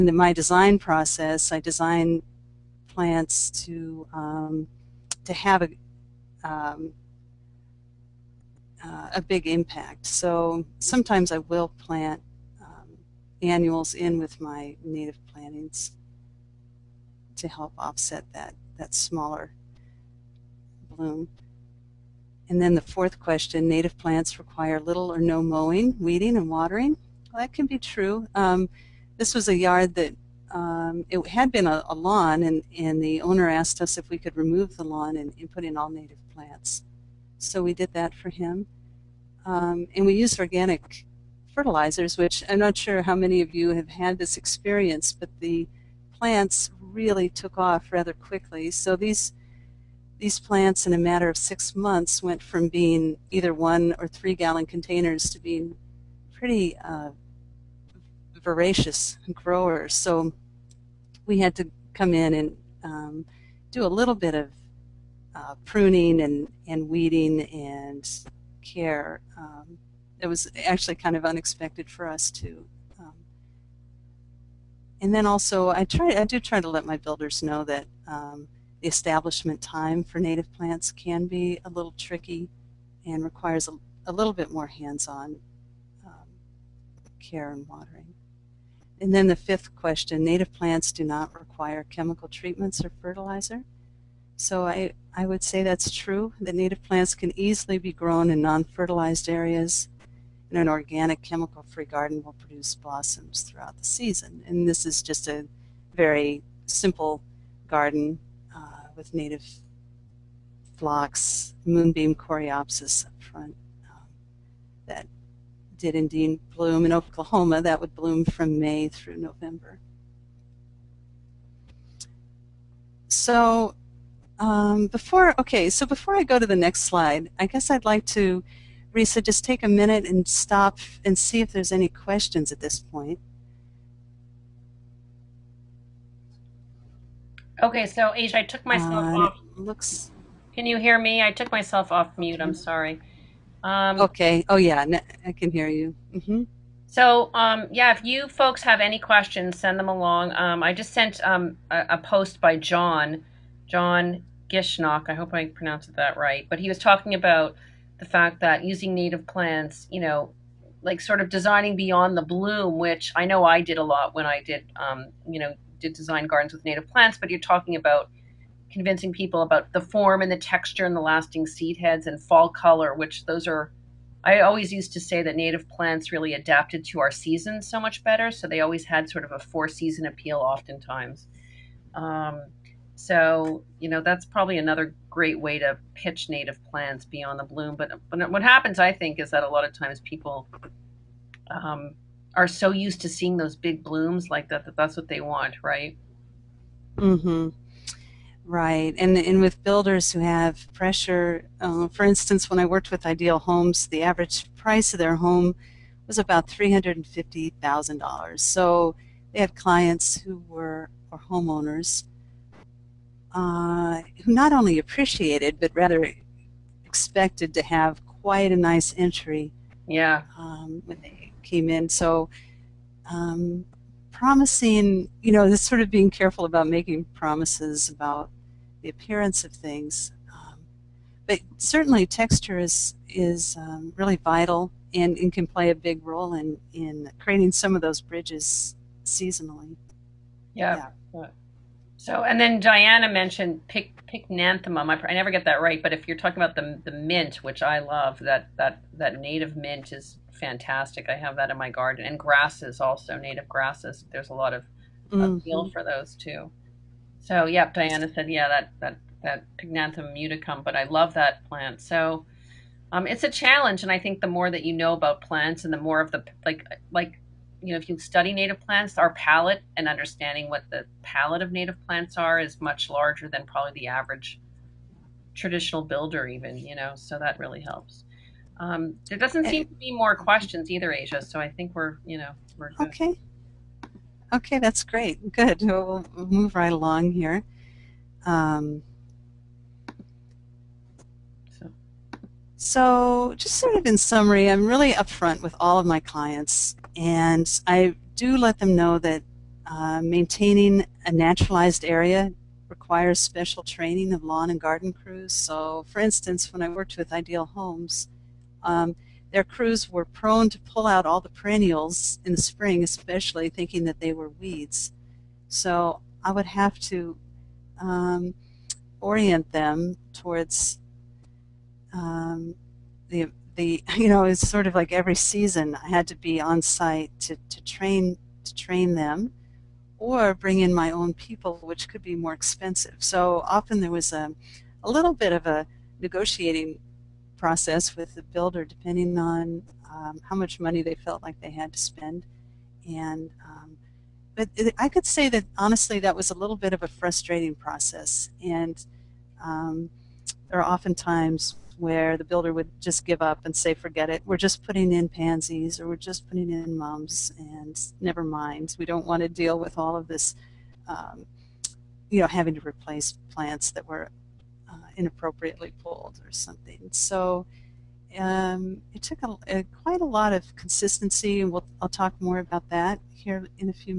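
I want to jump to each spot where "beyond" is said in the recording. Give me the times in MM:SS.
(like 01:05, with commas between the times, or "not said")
02:41, 03:07.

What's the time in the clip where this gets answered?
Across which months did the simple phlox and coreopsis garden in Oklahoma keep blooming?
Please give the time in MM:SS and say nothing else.
01:58.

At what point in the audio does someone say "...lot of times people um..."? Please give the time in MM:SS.
03:09.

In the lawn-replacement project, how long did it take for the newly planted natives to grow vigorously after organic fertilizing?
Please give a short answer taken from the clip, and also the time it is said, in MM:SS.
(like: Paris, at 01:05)
6 months, at 00:51.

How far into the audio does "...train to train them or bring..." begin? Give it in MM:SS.
05:27.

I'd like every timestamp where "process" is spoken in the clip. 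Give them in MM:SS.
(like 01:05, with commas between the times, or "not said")
00:00, 05:37, 05:47.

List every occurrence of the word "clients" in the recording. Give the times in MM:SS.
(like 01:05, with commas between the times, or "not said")
03:29, 04:55.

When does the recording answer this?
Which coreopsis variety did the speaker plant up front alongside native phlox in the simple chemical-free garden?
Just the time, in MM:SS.
01:51.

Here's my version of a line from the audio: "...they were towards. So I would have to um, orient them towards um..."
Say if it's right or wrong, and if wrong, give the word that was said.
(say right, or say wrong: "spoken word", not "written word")
wrong: "weeds", not "towards".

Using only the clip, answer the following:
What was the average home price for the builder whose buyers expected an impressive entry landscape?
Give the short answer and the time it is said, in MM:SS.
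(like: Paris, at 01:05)
$350,000, at 03:26.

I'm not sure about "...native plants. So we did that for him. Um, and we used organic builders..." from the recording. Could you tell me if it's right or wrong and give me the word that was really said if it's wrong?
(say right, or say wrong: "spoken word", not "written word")
wrong: "fertilizers", not "builders".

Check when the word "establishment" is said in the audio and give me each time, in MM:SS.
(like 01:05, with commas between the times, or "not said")
01:18.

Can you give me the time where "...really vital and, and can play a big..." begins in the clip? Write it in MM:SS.
03:53.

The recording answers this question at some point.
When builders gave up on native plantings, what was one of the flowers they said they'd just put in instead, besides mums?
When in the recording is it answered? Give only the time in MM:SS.
05:55.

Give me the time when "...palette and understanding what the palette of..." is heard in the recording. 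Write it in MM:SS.
04:29.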